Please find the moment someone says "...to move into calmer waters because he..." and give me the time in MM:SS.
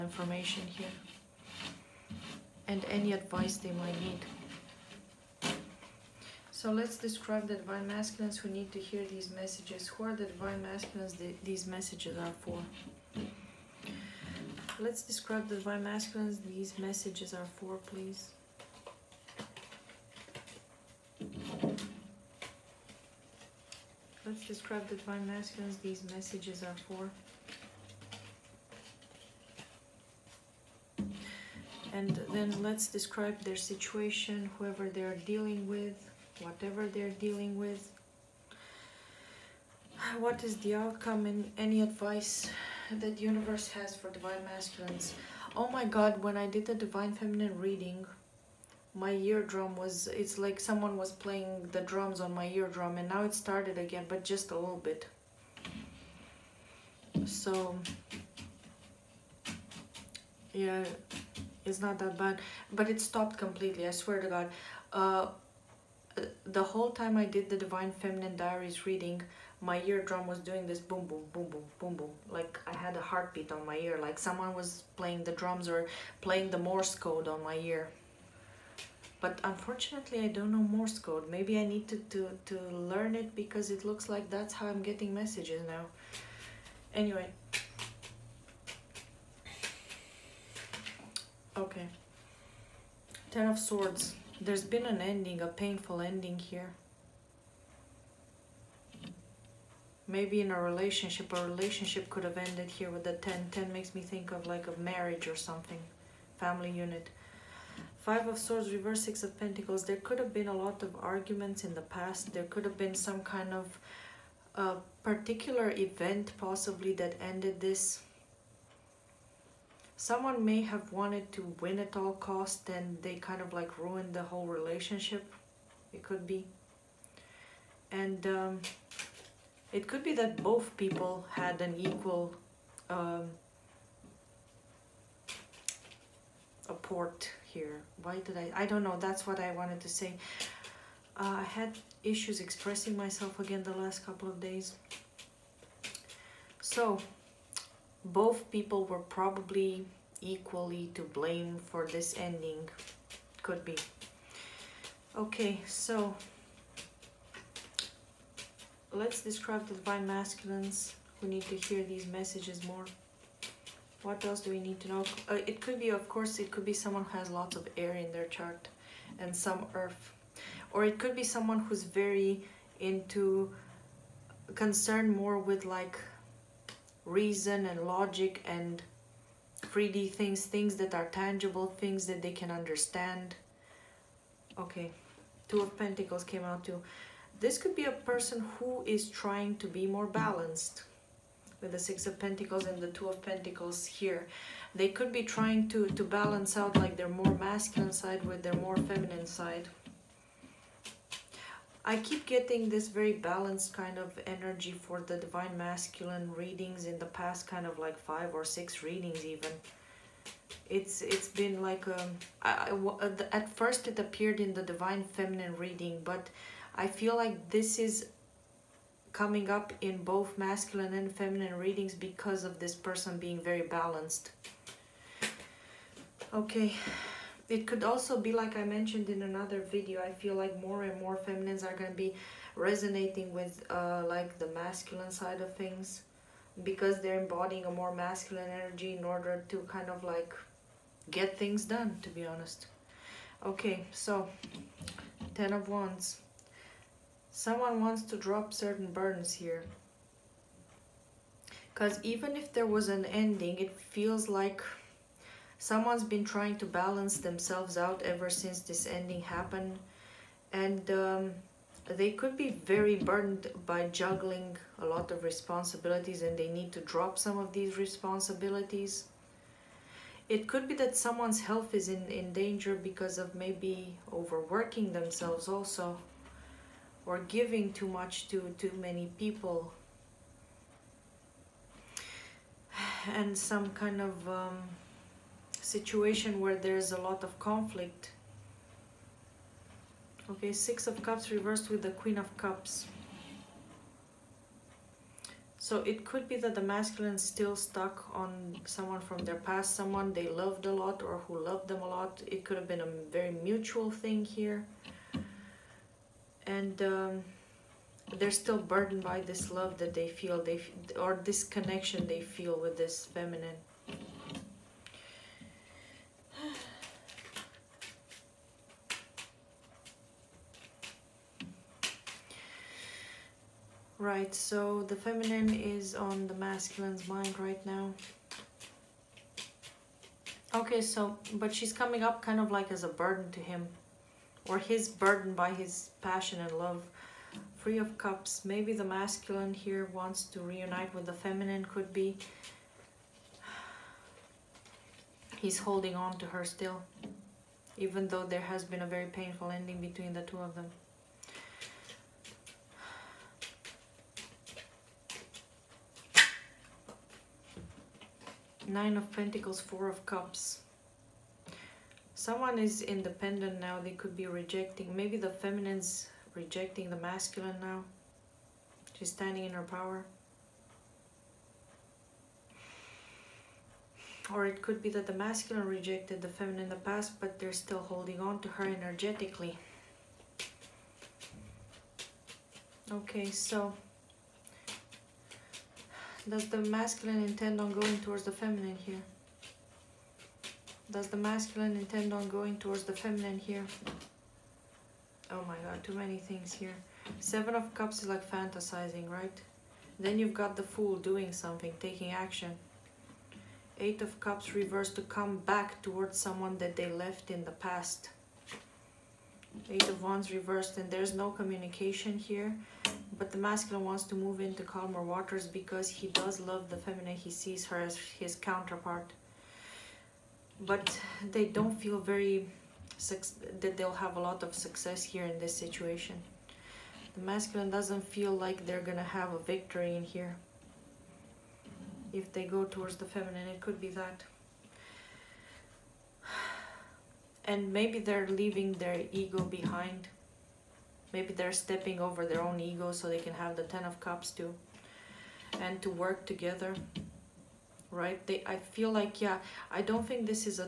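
06:54.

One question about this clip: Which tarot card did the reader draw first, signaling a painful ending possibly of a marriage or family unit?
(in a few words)
Ten of Swords.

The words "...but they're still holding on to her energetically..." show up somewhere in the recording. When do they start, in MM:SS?
06:17.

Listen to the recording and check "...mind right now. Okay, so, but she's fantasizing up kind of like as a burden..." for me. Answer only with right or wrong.
wrong.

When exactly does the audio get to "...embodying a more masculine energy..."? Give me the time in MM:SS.
03:57.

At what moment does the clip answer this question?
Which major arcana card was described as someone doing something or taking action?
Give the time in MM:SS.
06:40.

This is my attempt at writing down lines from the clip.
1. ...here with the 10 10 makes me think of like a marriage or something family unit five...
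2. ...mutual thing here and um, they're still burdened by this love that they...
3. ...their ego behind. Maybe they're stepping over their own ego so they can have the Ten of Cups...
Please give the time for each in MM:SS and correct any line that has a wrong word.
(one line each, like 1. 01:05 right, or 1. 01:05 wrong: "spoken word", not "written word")
1. 01:42 right
2. 05:03 right
3. 07:18 right.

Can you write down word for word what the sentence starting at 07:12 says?
If they go towards the feminine, it could be that.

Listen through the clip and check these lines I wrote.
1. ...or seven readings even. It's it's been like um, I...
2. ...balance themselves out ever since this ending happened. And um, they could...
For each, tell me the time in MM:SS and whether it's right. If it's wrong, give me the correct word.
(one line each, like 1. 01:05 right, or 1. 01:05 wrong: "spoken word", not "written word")
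1. 03:28 wrong: "six", not "seven"
2. 04:16 right.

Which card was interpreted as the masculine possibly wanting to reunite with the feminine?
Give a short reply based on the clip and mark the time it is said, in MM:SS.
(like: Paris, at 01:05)
Three of Cups, at 05:37.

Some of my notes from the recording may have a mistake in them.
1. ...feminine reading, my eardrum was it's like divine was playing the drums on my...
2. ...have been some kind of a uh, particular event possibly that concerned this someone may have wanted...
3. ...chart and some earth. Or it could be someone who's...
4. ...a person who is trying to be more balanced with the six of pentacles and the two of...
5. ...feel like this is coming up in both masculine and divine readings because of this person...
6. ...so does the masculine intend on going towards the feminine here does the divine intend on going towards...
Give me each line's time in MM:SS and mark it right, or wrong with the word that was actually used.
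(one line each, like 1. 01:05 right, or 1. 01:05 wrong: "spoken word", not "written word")
1. 00:47 wrong: "someone", not "divine"
2. 01:52 wrong: "ended", not "concerned"
3. 02:48 right
4. 03:07 right
5. 03:36 wrong: "feminine", not "divine"
6. 06:23 wrong: "masculine", not "divine".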